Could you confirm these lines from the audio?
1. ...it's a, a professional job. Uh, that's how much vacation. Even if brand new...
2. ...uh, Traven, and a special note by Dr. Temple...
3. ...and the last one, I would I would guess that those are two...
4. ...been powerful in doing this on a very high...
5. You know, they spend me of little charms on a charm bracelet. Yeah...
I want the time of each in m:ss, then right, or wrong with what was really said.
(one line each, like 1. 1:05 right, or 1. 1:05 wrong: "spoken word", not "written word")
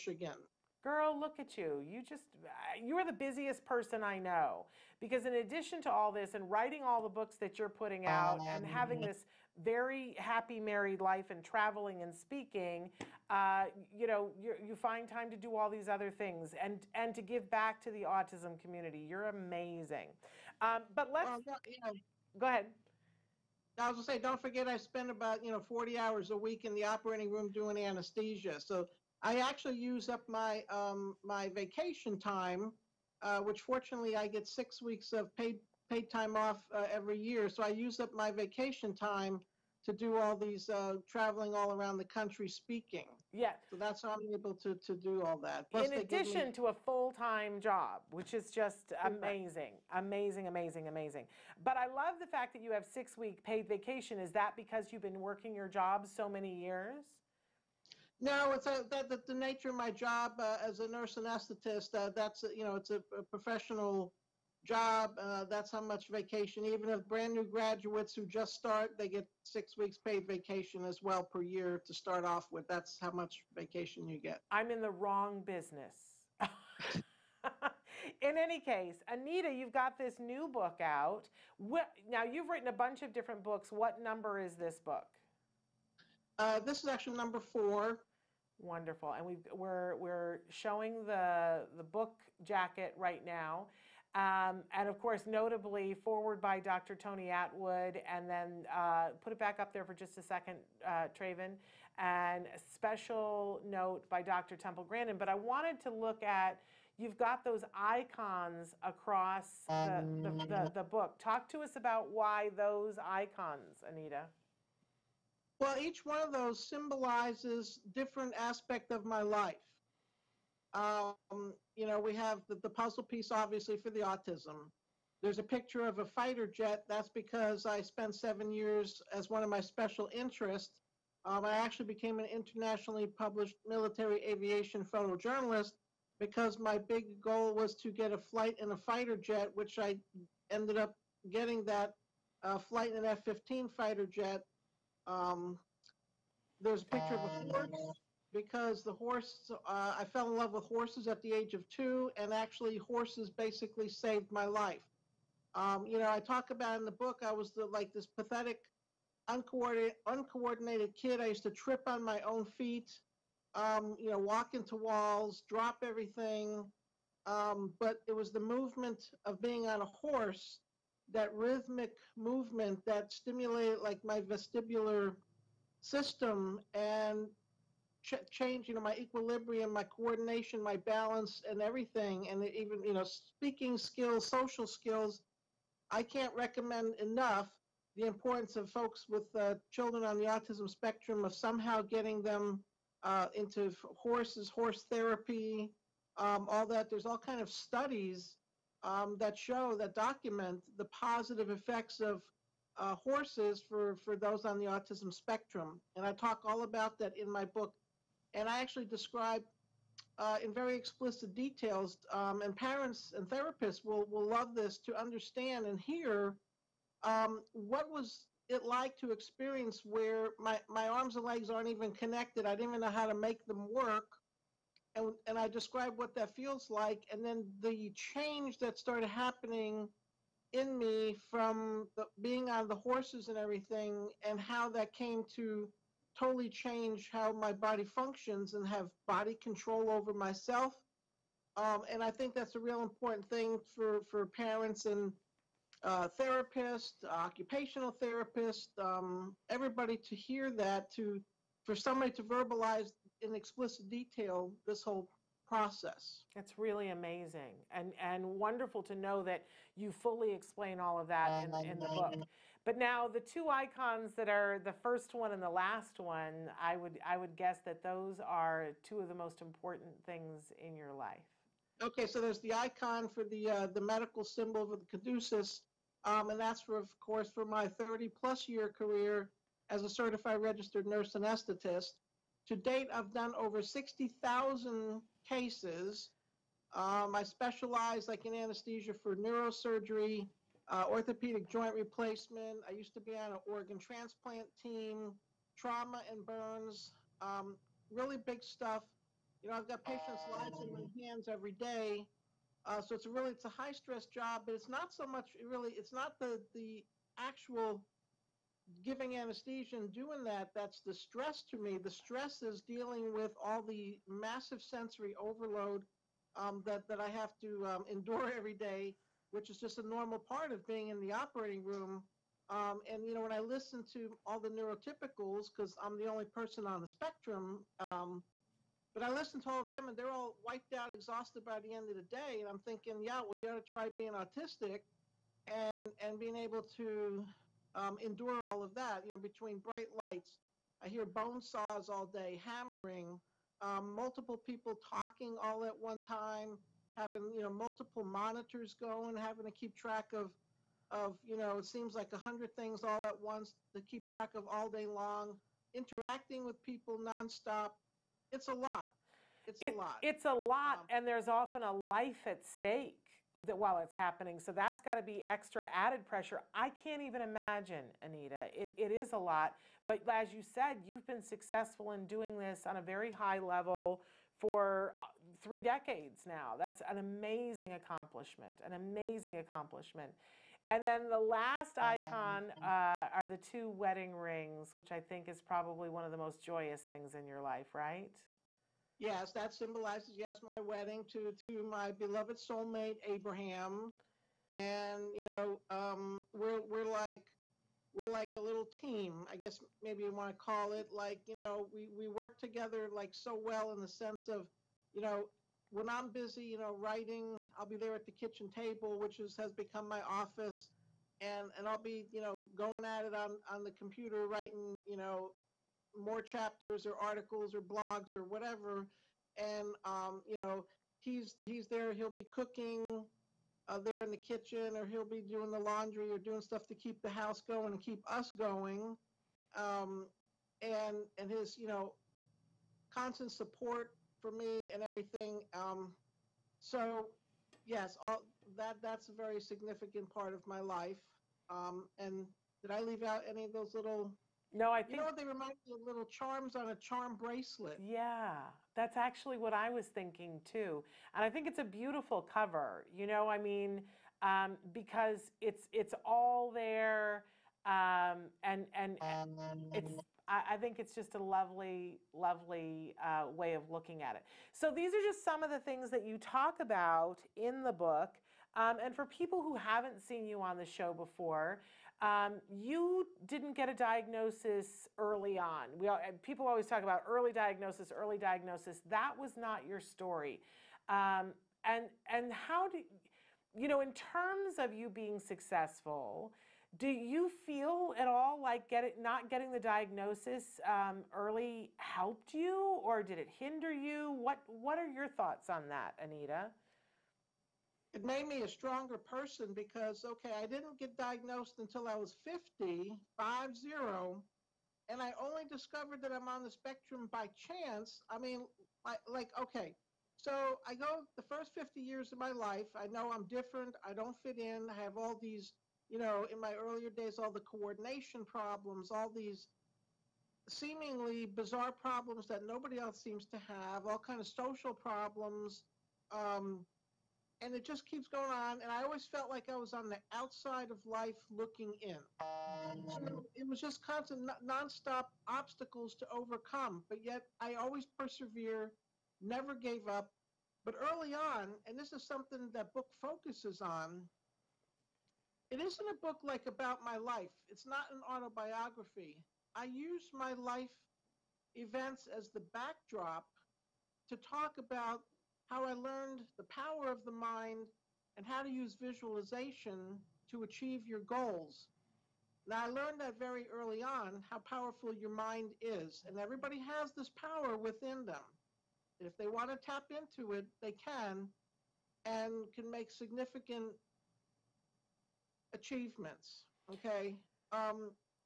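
1. 1:02 right
2. 1:40 right
3. 4:25 right
4. 6:11 wrong: "successful", not "powerful"
5. 7:24 wrong: "remind", not "spend".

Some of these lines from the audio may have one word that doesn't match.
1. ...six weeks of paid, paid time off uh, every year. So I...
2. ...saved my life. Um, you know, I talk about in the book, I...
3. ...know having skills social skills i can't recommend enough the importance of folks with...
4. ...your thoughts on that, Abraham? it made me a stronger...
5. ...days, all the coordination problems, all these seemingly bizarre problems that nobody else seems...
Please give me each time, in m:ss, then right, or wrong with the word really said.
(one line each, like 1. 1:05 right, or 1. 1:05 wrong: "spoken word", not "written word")
1. 0:34 right
2. 2:33 right
3. 3:02 wrong: "speaking", not "having"
4. 8:14 wrong: "Anita", not "Abraham"
5. 8:36 right.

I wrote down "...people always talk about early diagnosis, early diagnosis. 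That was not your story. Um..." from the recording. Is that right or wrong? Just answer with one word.
right.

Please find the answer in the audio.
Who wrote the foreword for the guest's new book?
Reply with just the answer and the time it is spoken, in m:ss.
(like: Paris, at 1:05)
Dr. Tony Attwood, at 1:36.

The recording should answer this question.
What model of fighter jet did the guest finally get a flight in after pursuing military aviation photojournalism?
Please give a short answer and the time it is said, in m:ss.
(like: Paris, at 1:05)
F-15, at 2:23.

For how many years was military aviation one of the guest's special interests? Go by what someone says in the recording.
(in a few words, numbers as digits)
7.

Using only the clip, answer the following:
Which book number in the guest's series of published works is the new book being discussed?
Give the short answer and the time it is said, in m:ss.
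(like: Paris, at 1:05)
4, at 1:27.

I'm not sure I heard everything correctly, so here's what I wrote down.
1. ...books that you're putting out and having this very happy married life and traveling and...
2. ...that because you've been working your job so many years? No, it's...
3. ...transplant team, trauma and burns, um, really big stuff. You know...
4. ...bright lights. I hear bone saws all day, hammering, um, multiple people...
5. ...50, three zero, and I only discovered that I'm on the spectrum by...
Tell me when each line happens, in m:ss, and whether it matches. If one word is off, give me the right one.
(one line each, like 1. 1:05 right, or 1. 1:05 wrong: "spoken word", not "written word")
1. 0:07 right
2. 0:54 right
3. 4:53 right
4. 5:39 right
5. 8:22 wrong: "five", not "three".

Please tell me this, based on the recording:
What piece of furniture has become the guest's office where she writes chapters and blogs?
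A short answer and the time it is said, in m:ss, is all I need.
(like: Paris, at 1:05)
kitchen table, at 6:48.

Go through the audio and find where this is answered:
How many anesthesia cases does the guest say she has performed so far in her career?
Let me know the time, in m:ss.
4:43.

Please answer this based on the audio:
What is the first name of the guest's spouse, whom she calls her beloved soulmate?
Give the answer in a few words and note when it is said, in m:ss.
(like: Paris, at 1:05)
Abraham, at 6:33.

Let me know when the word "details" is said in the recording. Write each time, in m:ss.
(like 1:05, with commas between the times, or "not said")
3:31, 4:13.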